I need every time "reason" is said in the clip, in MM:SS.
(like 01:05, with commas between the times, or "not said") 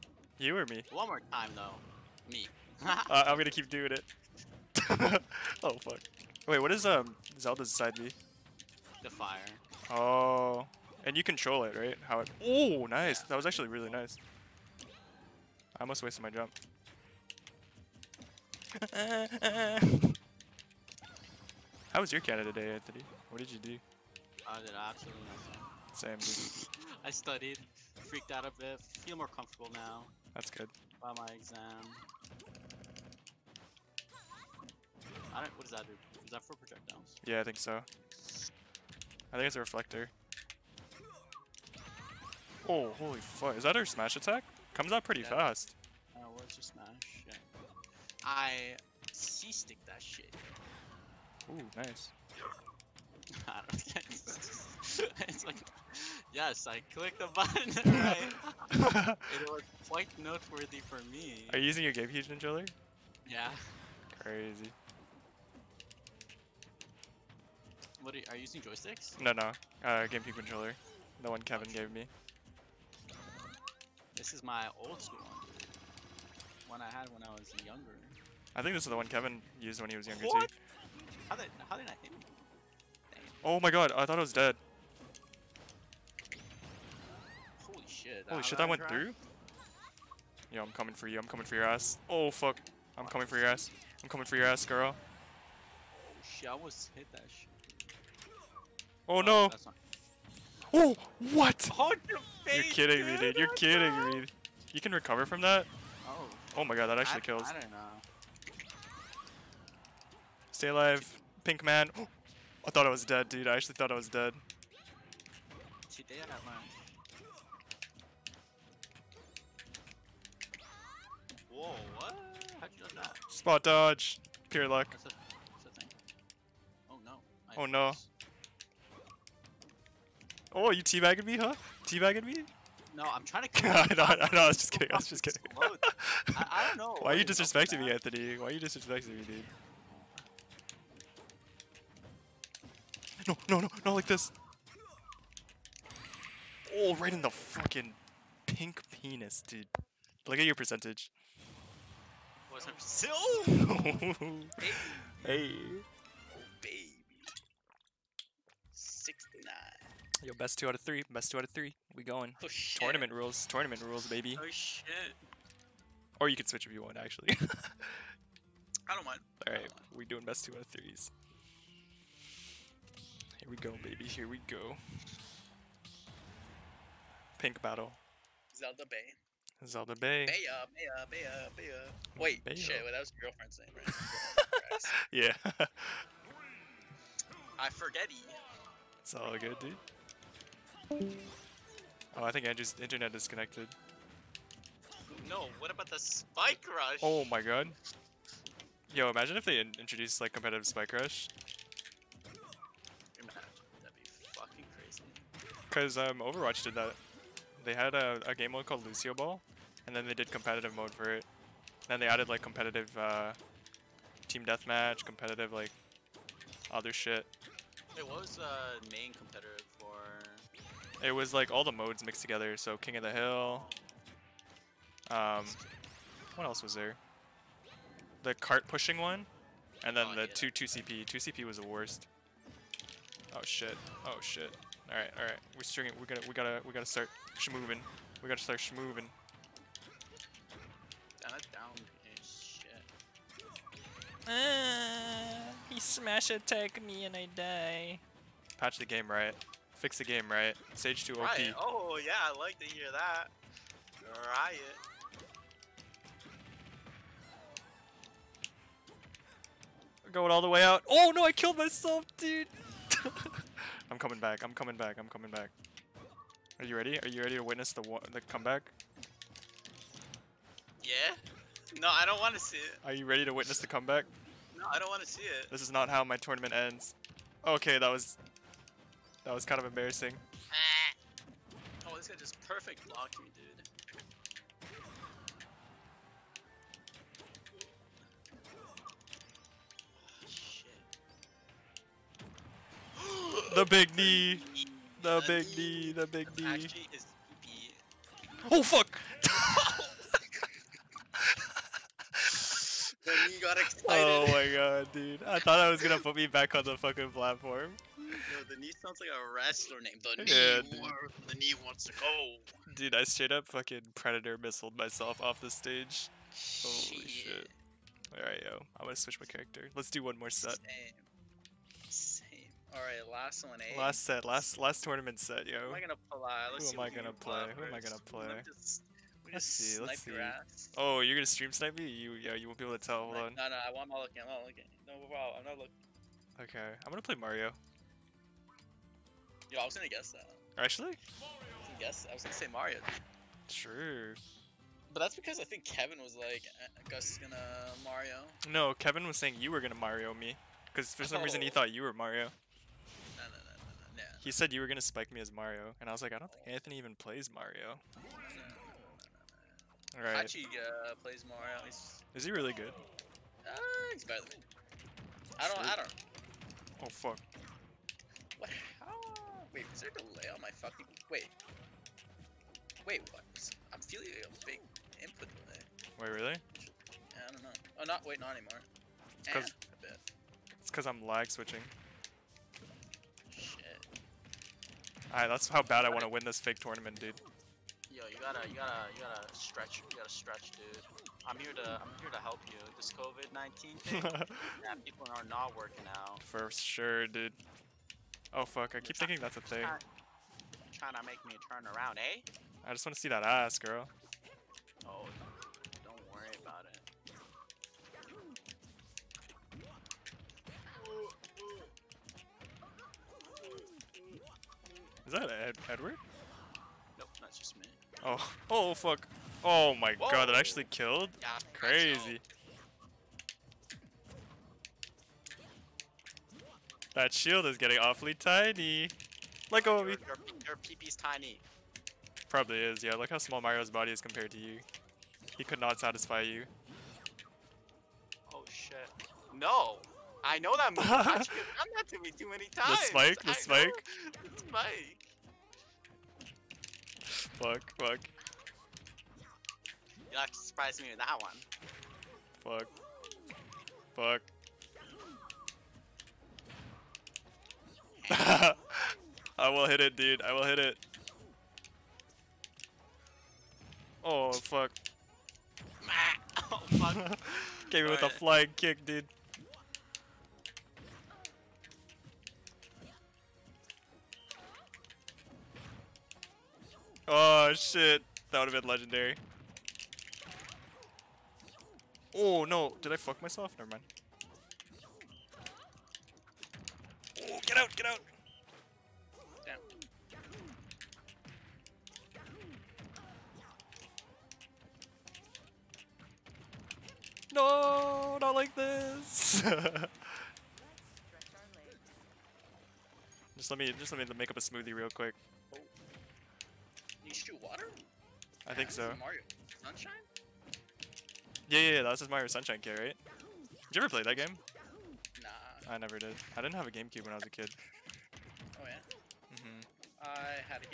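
05:51.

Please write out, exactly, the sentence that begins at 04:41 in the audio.
Oh, this guy just perfect blocked me, dude.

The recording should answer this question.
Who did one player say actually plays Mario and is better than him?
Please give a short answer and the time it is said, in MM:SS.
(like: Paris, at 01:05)
Hachi, at 06:00.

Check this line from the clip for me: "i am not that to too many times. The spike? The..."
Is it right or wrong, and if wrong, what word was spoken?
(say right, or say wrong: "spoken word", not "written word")
right.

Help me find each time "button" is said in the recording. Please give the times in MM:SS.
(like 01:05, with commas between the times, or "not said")
00:57.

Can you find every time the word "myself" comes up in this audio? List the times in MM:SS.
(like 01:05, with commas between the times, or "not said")
04:21, 05:14, 08:03.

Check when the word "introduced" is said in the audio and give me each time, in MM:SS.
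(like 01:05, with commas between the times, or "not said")
03:19.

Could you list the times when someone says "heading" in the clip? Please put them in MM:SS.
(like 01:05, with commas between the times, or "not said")
not said.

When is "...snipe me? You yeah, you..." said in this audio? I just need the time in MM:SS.
05:31.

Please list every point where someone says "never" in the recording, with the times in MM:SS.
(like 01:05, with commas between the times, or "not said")
08:03, 08:35.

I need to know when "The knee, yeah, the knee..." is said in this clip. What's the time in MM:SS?
05:10.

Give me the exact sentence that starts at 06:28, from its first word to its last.
Yo, you gotta, you gotta, you gotta stretch.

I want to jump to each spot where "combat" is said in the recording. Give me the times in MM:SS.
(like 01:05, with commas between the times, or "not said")
not said.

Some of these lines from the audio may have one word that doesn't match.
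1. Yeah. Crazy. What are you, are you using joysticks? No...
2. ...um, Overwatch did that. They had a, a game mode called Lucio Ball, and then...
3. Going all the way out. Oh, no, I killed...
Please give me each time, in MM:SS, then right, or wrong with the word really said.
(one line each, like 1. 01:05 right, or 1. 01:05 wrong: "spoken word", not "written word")
1. 01:03 right
2. 03:25 right
3. 04:20 right.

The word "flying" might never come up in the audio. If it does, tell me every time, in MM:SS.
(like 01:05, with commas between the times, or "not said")
07:48.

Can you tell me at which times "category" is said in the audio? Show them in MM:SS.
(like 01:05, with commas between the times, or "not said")
not said.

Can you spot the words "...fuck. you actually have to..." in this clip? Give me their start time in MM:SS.
07:27.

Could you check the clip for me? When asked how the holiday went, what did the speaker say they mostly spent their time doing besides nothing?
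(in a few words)
Studied.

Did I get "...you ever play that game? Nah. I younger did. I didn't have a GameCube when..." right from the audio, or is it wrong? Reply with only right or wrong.
wrong.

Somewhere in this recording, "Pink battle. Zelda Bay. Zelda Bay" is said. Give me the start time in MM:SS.
02:57.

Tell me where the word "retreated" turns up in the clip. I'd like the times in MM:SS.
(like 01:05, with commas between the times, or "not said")
not said.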